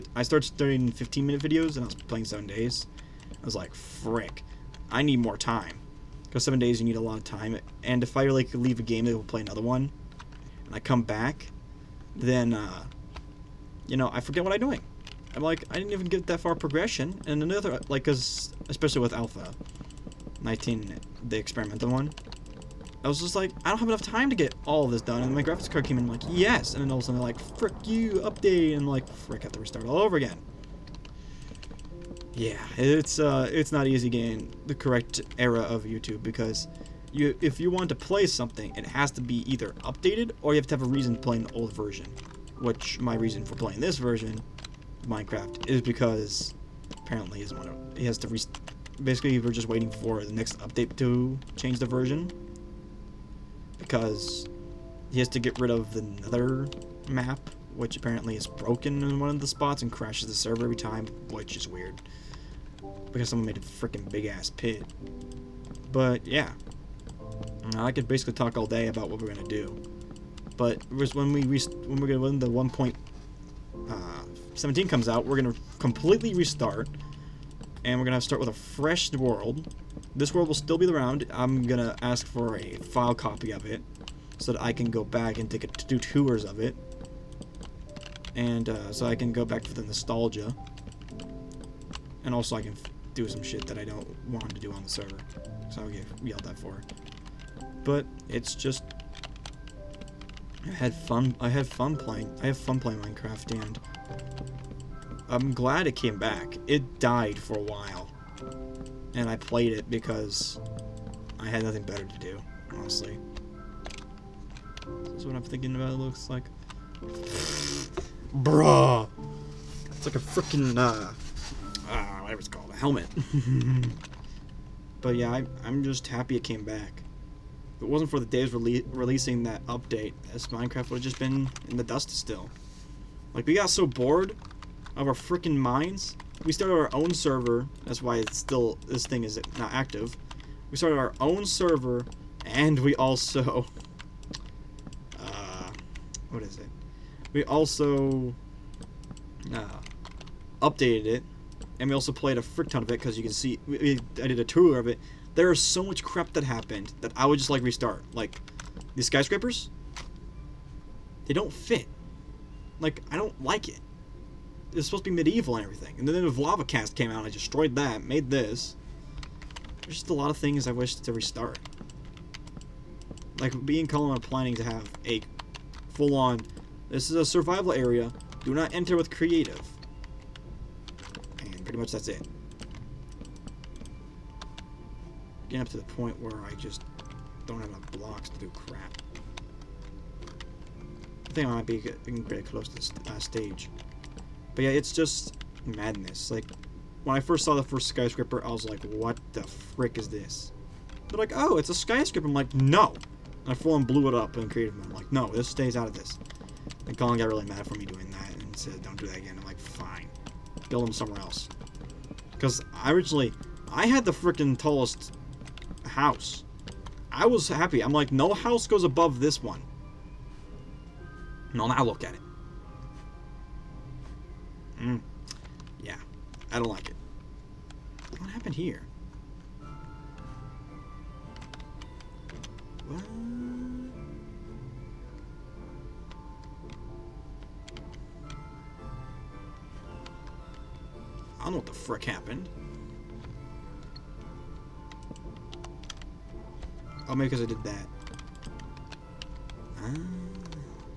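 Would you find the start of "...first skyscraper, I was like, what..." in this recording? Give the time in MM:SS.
03:17.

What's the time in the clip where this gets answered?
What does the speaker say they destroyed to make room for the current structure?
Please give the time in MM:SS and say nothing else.
02:46.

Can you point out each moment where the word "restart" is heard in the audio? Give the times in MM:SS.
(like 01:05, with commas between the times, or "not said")
00:29, 01:16, 02:37, 02:51.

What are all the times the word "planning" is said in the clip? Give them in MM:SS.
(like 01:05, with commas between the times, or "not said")
02:54.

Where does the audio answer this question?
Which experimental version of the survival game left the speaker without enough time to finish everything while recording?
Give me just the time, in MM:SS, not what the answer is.
00:19.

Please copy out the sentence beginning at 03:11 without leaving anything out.
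I think I might be getting pretty close to the uh, stage.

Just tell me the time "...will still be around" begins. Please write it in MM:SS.
01:20.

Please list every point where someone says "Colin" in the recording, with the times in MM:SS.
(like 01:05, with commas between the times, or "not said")
02:53, 03:26.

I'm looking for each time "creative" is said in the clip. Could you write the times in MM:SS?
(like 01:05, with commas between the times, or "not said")
02:59, 03:24.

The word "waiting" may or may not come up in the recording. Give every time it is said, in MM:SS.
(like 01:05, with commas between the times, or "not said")
00:49.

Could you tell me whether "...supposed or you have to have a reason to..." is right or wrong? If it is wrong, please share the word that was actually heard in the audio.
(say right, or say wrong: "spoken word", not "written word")
wrong: "updated", not "supposed".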